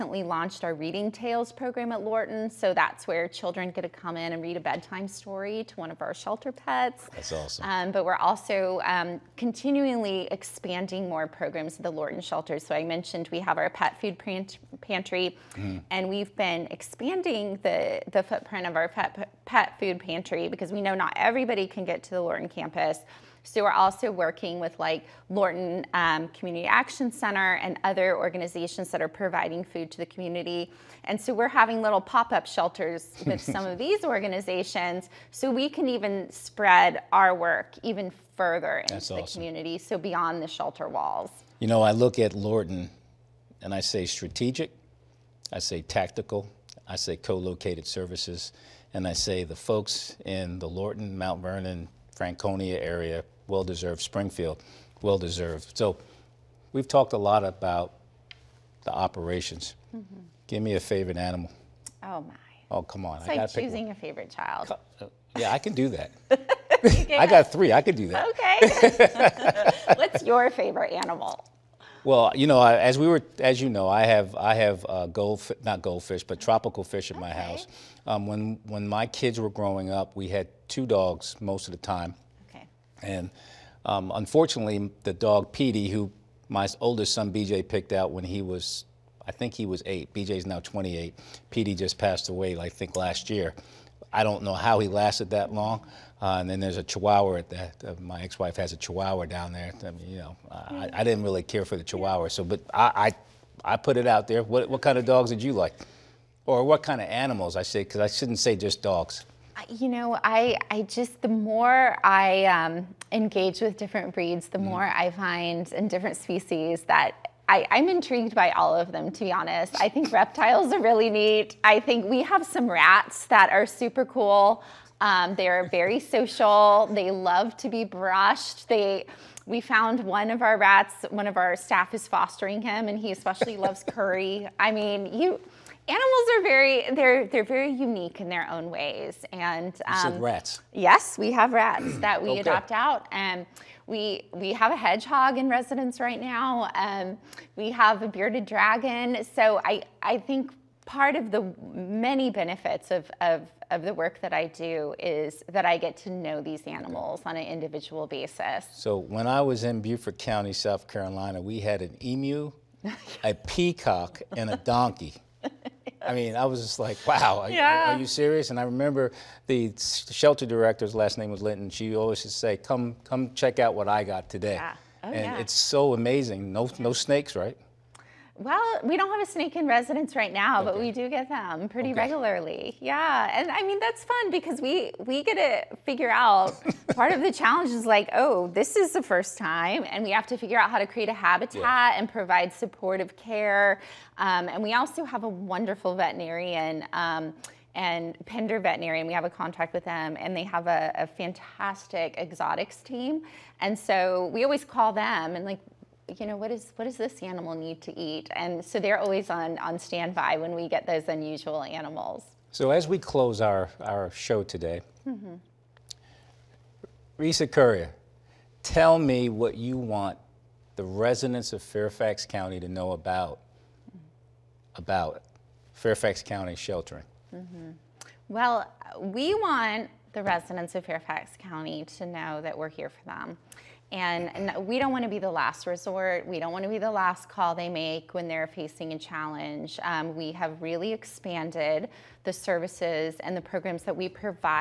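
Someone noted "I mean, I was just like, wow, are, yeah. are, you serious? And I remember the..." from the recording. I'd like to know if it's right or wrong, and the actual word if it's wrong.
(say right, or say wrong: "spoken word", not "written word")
right.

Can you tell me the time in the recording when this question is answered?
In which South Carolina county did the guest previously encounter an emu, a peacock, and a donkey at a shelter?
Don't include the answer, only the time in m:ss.
2:39.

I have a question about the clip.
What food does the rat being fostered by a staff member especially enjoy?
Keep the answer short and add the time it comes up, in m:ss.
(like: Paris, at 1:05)
Curry, at 2:13.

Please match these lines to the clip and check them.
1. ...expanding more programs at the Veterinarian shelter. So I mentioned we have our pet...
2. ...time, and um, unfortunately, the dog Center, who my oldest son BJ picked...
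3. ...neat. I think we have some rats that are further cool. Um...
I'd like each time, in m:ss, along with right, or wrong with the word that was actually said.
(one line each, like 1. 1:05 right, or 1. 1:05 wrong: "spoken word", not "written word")
1. 0:10 wrong: "Lorton", not "Veterinarian"
2. 1:21 wrong: "Petey", not "Center"
3. 2:01 wrong: "super", not "further".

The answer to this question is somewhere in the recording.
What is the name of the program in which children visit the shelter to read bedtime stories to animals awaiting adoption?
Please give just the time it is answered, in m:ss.
0:00.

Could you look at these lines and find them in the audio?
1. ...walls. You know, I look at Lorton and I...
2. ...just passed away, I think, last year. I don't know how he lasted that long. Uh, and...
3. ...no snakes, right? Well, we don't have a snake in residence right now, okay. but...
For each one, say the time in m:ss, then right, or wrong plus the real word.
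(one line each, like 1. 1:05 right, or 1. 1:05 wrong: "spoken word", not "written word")
1. 0:40 right
2. 1:31 right
3. 2:56 right.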